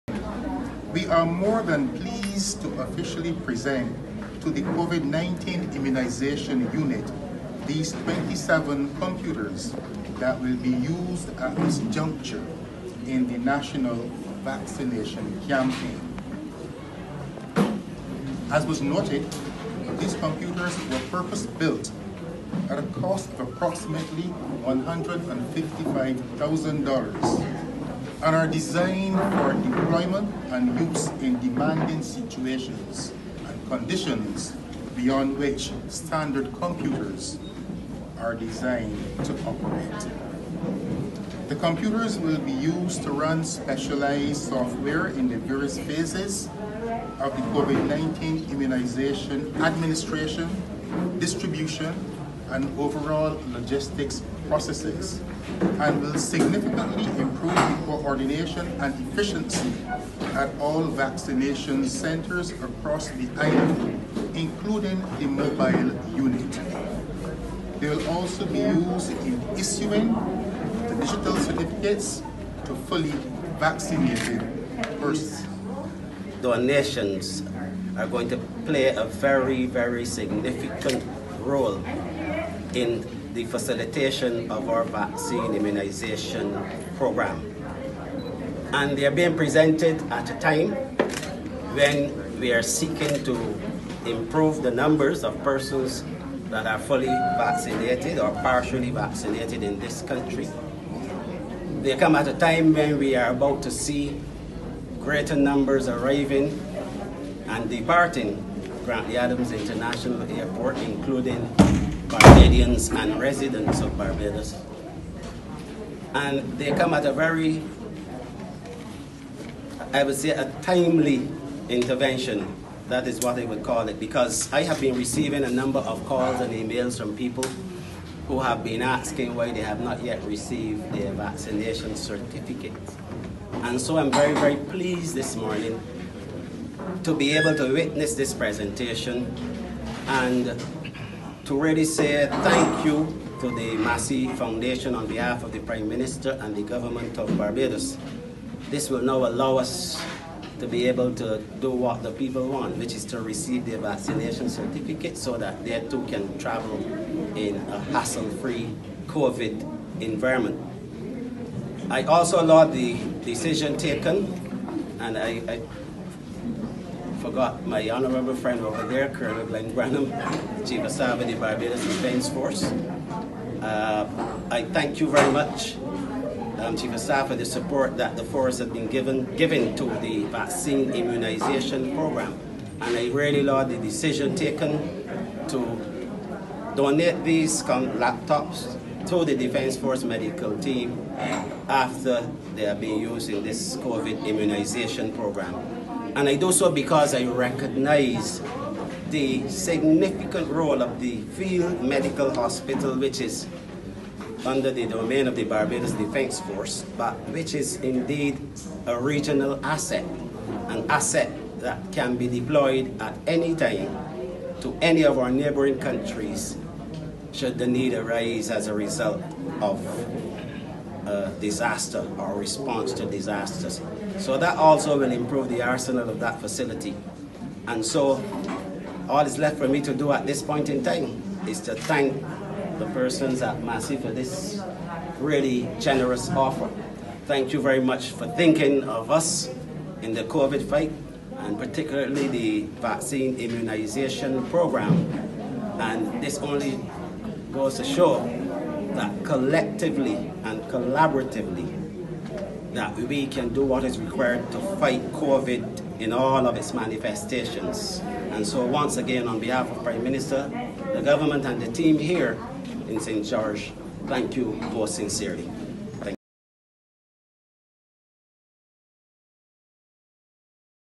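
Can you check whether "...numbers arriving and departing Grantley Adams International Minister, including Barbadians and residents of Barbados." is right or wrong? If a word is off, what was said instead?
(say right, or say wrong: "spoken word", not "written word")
wrong: "Airport", not "Minister".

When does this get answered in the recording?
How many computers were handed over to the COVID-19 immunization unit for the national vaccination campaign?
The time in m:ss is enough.
0:08.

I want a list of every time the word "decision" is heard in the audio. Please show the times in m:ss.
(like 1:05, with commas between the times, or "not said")
2:43, 3:03.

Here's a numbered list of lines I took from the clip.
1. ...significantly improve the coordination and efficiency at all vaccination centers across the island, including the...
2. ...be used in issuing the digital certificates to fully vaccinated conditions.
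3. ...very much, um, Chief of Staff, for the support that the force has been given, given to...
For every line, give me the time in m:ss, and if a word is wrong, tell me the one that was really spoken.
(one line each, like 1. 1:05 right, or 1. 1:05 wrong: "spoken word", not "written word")
1. 0:56 right
2. 1:08 wrong: "persons", not "conditions"
3. 2:55 right.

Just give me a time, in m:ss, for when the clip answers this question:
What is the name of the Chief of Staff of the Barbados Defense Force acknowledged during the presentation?
2:49.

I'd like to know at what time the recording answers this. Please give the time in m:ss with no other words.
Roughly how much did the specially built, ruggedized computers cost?
0:24.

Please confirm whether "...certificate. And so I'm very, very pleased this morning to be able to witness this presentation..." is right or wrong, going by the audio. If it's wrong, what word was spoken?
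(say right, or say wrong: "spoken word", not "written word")
right.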